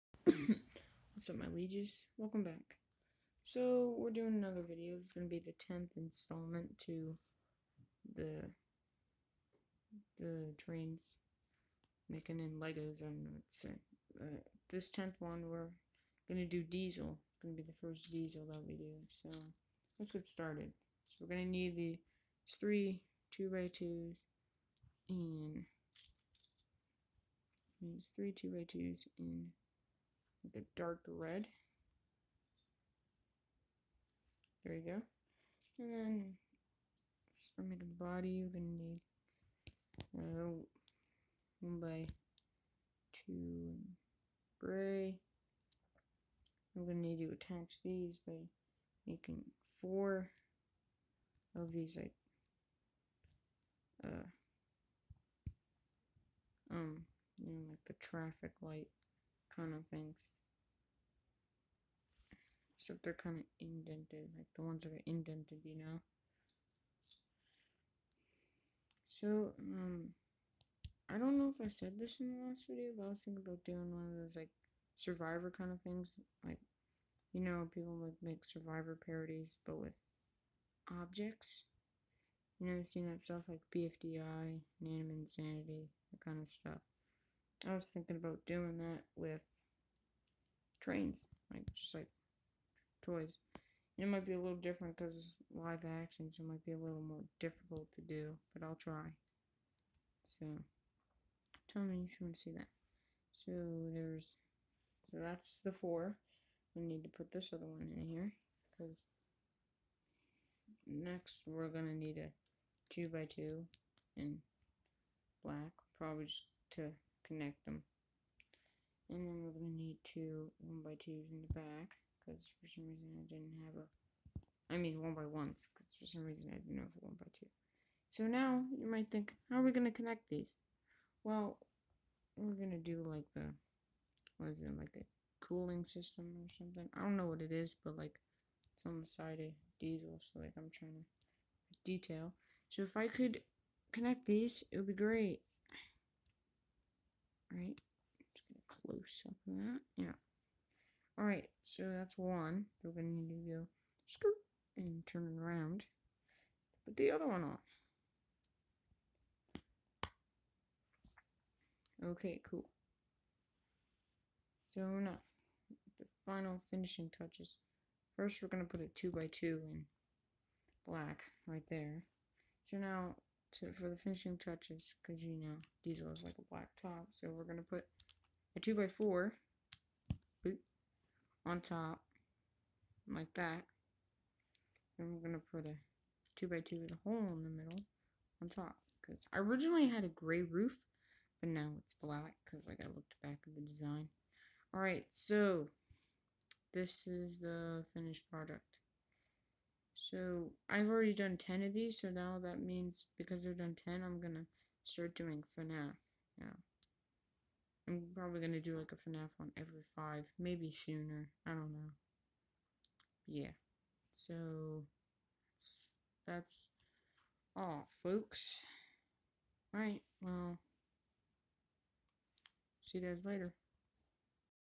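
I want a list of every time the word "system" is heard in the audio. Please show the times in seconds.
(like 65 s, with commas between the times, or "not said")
135 s.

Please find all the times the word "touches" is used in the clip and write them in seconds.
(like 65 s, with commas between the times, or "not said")
167 s, 174 s.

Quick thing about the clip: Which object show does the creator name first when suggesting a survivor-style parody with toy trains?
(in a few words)
BFDI.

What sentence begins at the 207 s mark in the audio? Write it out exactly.
I'm probably going to do like a FNAF on every 5, maybe sooner, I don't know.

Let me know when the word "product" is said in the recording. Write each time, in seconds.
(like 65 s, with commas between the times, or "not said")
198 s.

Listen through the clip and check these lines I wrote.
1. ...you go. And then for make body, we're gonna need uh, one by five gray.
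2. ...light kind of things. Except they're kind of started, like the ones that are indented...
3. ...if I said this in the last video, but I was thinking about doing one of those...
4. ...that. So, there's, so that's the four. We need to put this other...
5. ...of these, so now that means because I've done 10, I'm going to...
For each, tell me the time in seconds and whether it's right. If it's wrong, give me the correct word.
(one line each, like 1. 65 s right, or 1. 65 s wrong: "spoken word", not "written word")
1. 34 s wrong: "two", not "five"
2. 58 s wrong: "indented", not "started"
3. 71 s right
4. 102 s right
5. 201 s right.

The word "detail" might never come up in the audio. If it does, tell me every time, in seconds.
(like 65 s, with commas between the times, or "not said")
141 s.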